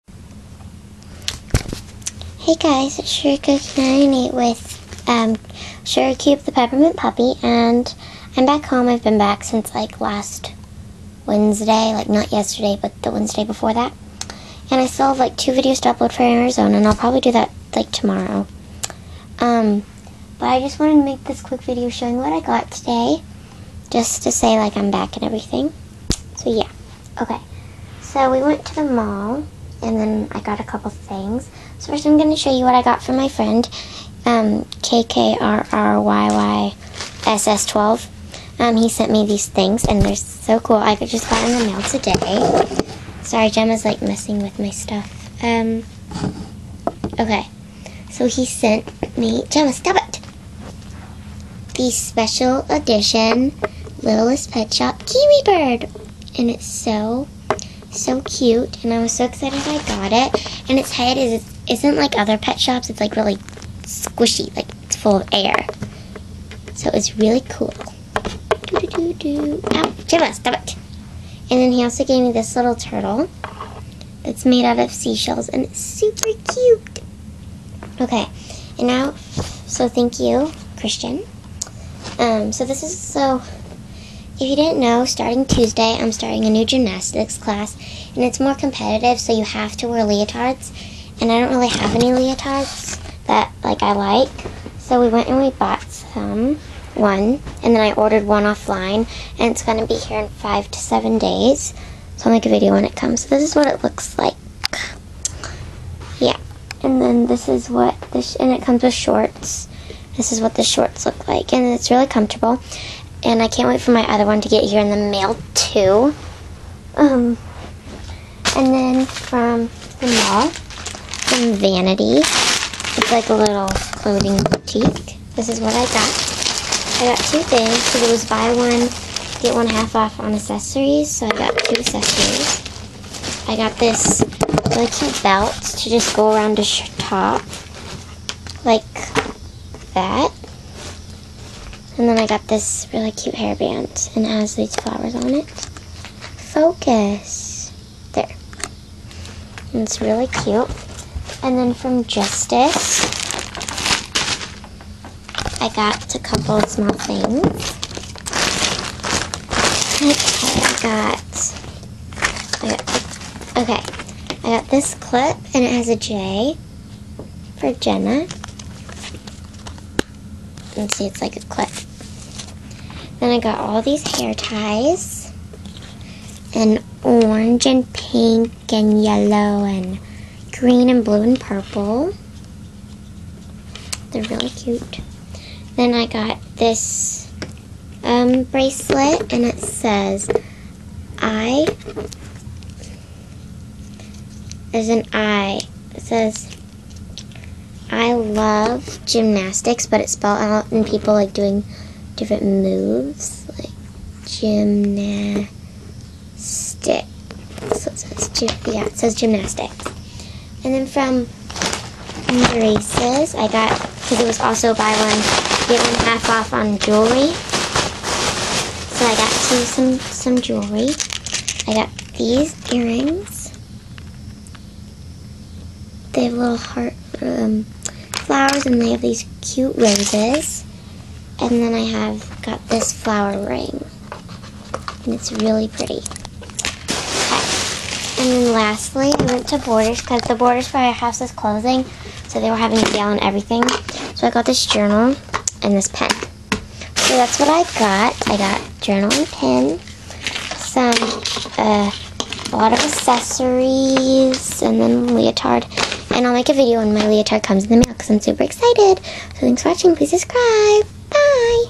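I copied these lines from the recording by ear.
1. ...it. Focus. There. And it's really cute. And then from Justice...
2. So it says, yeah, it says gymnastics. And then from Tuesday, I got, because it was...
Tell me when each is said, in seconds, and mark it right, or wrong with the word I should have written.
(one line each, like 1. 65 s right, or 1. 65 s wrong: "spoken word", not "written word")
1. 145 s right
2. 206 s wrong: "Races", not "Tuesday".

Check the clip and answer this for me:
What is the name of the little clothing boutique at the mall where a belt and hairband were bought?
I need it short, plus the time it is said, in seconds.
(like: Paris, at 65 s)
Vanity, at 121 s.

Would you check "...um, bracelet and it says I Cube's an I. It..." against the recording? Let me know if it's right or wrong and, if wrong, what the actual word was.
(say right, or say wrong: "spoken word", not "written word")
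wrong: "There", not "Cube".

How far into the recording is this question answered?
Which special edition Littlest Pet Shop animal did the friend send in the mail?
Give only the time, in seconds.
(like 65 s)
55 s.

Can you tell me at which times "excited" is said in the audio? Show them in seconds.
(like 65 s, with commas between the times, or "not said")
59 s, 258 s.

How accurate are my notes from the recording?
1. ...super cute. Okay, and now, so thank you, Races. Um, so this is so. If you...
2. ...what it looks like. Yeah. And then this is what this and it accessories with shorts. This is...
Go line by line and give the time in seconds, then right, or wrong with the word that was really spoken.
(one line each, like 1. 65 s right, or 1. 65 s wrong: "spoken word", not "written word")
1. 75 s wrong: "Christian", not "Races"
2. 103 s wrong: "comes", not "accessories".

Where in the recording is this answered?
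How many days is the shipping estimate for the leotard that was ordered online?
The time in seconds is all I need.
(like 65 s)
100 s.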